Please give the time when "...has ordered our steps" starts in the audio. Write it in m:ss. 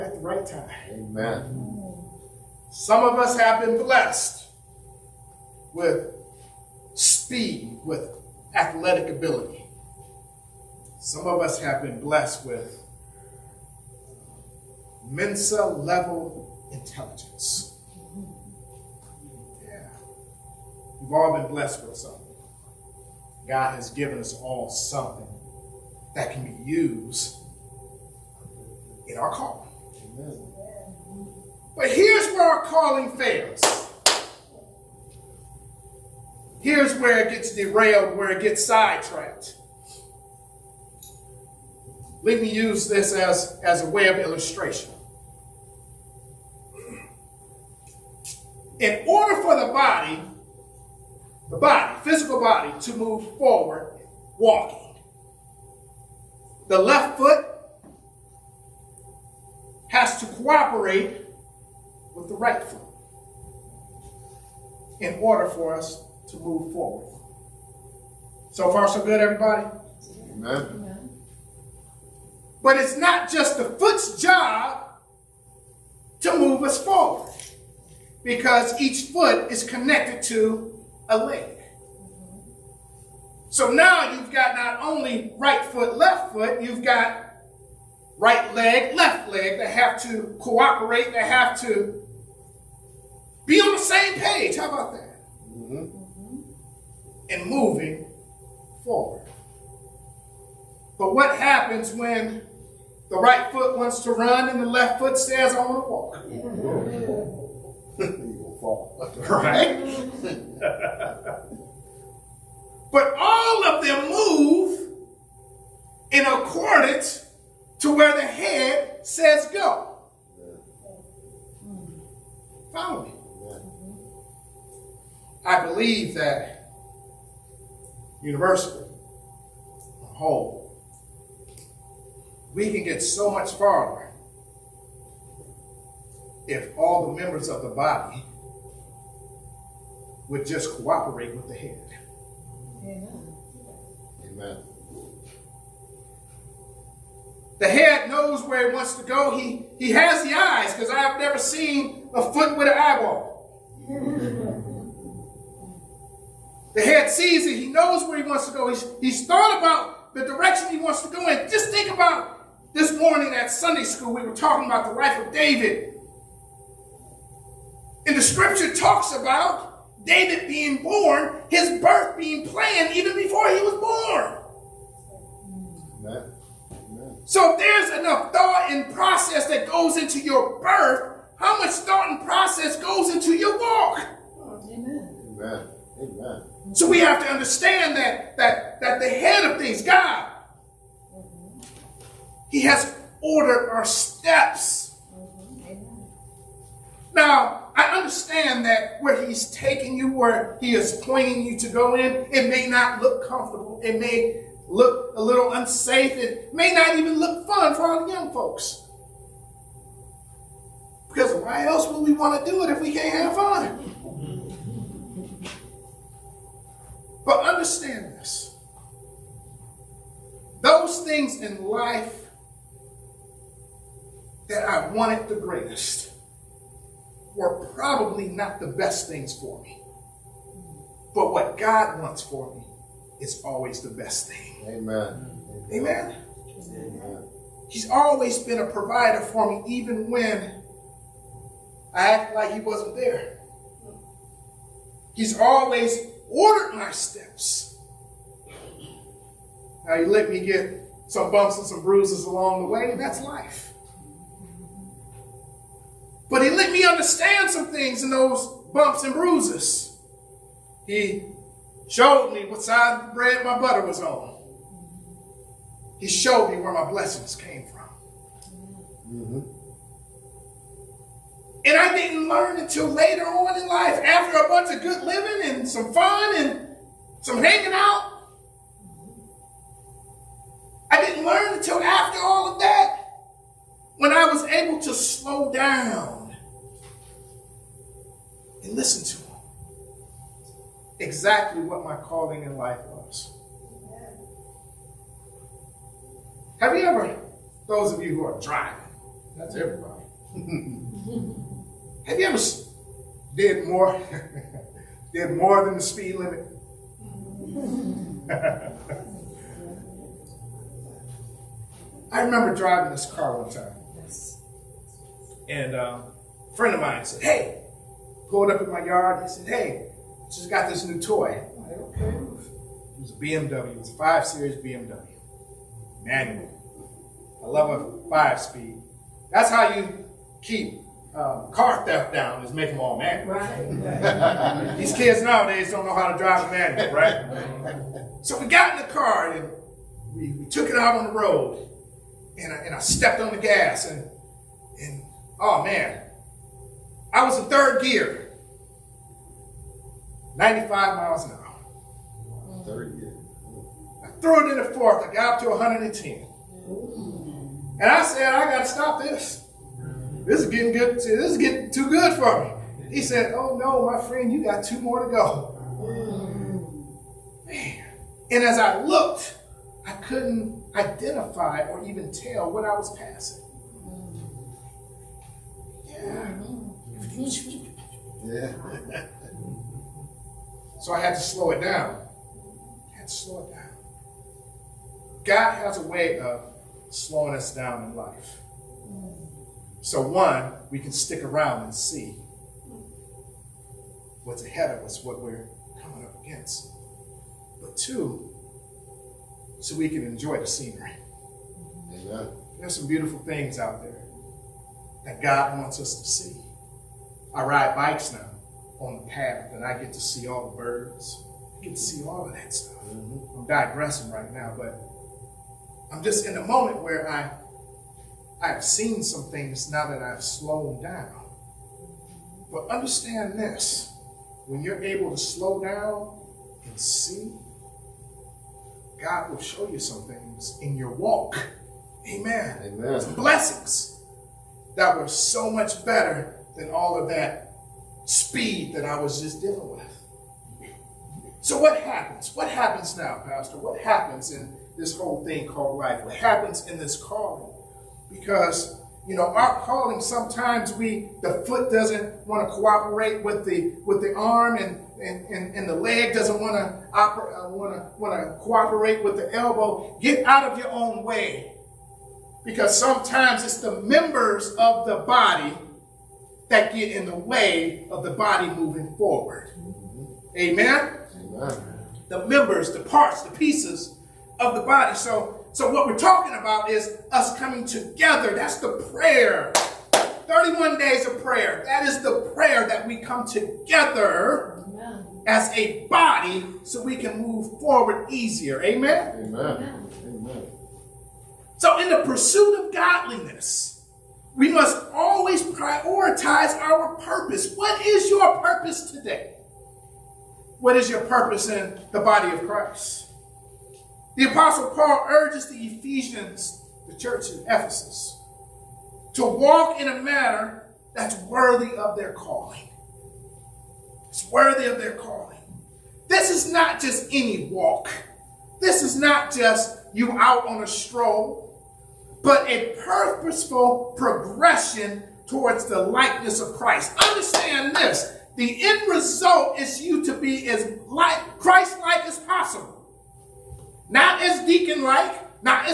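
3:12.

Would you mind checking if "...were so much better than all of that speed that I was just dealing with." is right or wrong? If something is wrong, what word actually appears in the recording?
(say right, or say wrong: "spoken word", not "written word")
right.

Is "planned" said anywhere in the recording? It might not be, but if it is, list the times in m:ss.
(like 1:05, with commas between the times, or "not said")
2:52.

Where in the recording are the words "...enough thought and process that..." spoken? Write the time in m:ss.
2:57.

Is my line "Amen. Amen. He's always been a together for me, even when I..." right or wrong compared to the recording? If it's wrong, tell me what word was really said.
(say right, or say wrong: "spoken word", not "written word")
wrong: "provider", not "together".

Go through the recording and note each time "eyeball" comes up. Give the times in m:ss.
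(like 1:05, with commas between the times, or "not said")
2:32.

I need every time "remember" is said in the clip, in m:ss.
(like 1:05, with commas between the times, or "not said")
5:12.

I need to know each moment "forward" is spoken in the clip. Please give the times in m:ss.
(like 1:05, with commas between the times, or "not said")
0:53, 1:06, 1:16, 1:38, 7:48, 8:07.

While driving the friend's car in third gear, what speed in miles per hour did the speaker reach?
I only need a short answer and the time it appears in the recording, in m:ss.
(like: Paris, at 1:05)
95, at 5:50.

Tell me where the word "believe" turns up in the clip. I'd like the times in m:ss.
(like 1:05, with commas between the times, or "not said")
2:05.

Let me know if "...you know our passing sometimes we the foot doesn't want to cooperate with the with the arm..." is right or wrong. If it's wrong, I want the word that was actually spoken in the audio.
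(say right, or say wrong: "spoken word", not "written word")
wrong: "calling", not "passing".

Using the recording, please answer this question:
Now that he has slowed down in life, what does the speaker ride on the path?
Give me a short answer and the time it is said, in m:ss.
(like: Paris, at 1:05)
bikes, at 6:47.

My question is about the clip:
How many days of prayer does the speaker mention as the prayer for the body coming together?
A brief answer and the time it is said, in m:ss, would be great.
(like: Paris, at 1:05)
31, at 8:00.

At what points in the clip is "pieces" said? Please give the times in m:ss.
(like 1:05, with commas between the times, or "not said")
7:53.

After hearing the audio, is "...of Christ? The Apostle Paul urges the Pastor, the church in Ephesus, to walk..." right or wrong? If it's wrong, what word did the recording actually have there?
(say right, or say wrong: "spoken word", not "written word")
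wrong: "Ephesians", not "Pastor".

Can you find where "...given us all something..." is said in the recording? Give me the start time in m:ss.
0:23.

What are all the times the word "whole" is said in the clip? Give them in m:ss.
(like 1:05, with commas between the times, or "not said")
2:10, 7:24.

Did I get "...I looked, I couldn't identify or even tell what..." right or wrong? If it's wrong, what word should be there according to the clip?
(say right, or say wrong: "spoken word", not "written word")
right.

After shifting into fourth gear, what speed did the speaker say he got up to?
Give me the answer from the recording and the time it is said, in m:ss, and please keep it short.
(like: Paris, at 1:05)
110, at 5:55.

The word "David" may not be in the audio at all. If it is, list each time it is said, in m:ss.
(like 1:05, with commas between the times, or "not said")
2:45, 2:50.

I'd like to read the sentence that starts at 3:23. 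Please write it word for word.
It may look a little unsafe.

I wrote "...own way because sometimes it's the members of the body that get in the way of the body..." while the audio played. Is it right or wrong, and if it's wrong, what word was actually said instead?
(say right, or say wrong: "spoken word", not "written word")
right.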